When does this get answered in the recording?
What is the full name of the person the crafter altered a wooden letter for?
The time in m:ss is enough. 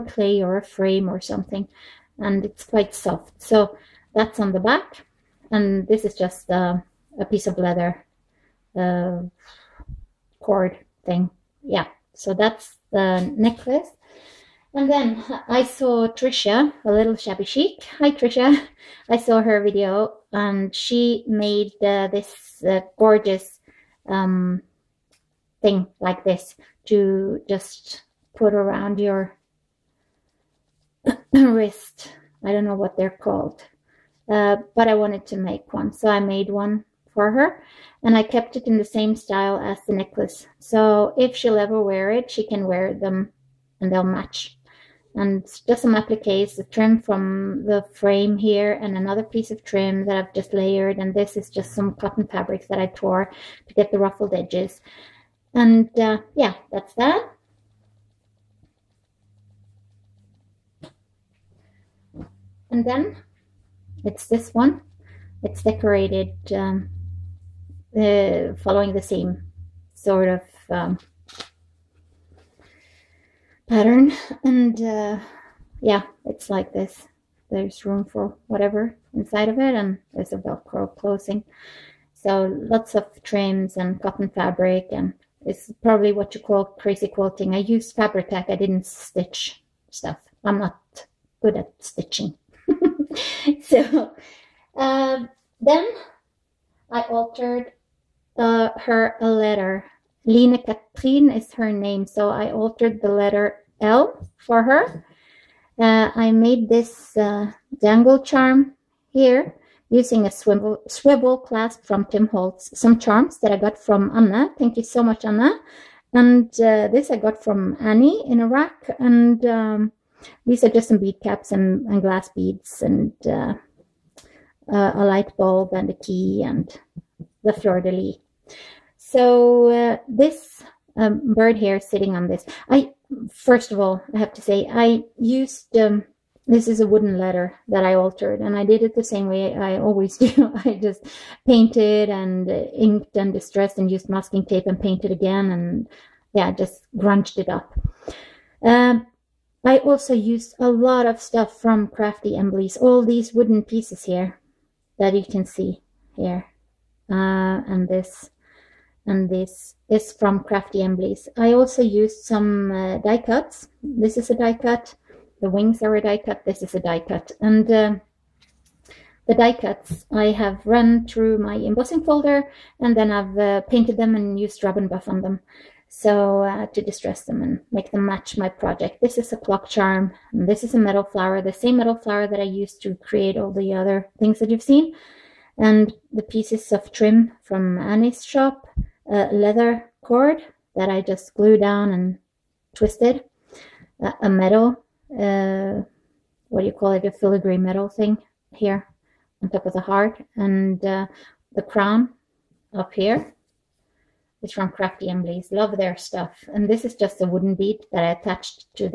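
1:40.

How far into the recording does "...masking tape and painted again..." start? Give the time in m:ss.
2:24.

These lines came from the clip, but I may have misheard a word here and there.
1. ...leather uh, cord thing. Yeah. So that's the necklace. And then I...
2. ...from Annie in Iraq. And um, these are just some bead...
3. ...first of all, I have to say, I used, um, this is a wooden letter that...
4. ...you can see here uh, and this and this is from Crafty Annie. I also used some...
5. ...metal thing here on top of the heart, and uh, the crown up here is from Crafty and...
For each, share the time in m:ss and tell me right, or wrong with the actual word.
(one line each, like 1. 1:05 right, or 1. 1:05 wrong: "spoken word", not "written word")
1. 0:07 right
2. 1:57 right
3. 2:13 right
4. 2:35 wrong: "Emblies", not "Annie"
5. 3:17 right.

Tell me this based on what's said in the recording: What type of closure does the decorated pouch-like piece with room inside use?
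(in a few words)
velcro.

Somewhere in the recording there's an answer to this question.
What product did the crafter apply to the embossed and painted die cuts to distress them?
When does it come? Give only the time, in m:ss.
2:54.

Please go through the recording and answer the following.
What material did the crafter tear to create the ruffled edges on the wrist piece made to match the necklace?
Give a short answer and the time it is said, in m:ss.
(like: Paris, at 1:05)
cotton fabrics, at 0:51.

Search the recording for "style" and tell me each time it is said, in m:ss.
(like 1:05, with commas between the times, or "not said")
0:39.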